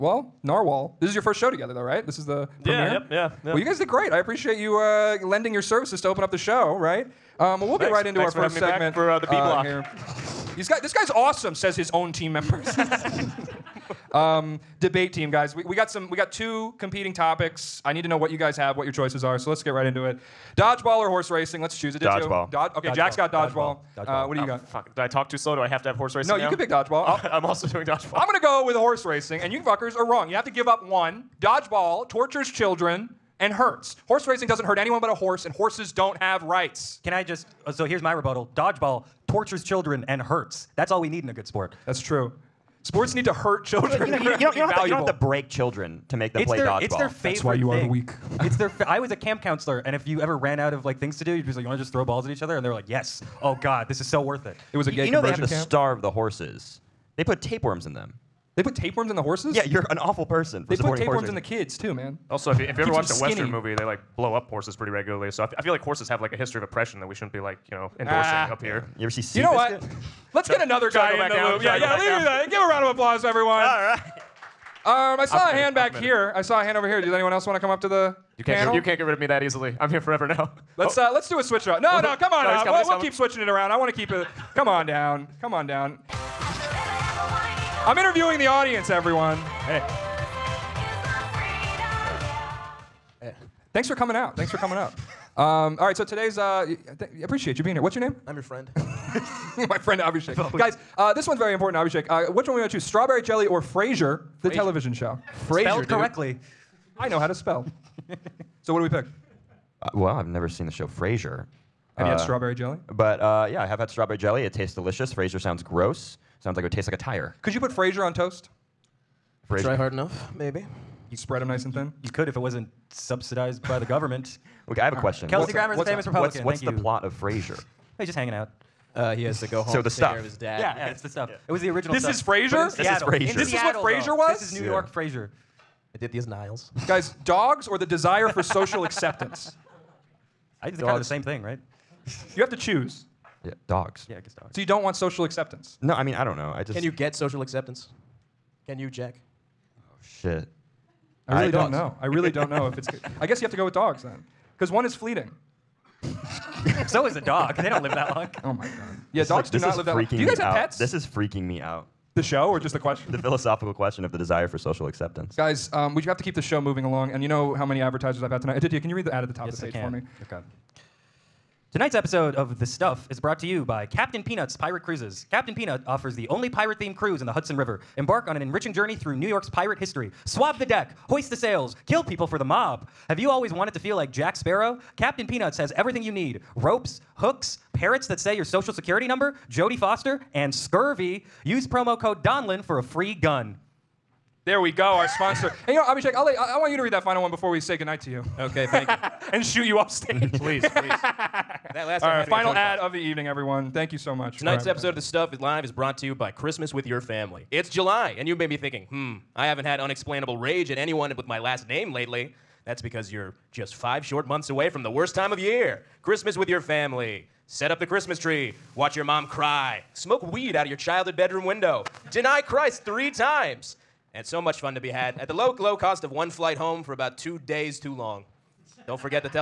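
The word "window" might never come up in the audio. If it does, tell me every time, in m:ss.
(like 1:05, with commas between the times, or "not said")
3:41.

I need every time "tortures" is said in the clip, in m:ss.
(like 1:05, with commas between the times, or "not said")
0:32, 0:39.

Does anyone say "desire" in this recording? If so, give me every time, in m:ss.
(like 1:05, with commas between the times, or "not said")
2:17, 2:44.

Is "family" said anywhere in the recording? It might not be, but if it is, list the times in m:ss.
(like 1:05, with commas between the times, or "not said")
3:26, 3:36.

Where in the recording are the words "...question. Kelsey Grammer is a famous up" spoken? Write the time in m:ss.
2:04.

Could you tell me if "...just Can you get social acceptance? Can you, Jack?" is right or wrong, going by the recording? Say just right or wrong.
right.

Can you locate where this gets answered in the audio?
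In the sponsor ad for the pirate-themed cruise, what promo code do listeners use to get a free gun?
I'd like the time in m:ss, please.
3:11.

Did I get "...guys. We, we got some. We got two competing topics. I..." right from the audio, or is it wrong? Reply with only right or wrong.
right.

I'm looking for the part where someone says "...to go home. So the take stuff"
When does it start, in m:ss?
2:09.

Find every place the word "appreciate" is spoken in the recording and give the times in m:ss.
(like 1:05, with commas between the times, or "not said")
0:04, 1:37.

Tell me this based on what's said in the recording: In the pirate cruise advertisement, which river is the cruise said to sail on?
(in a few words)
Hudson River.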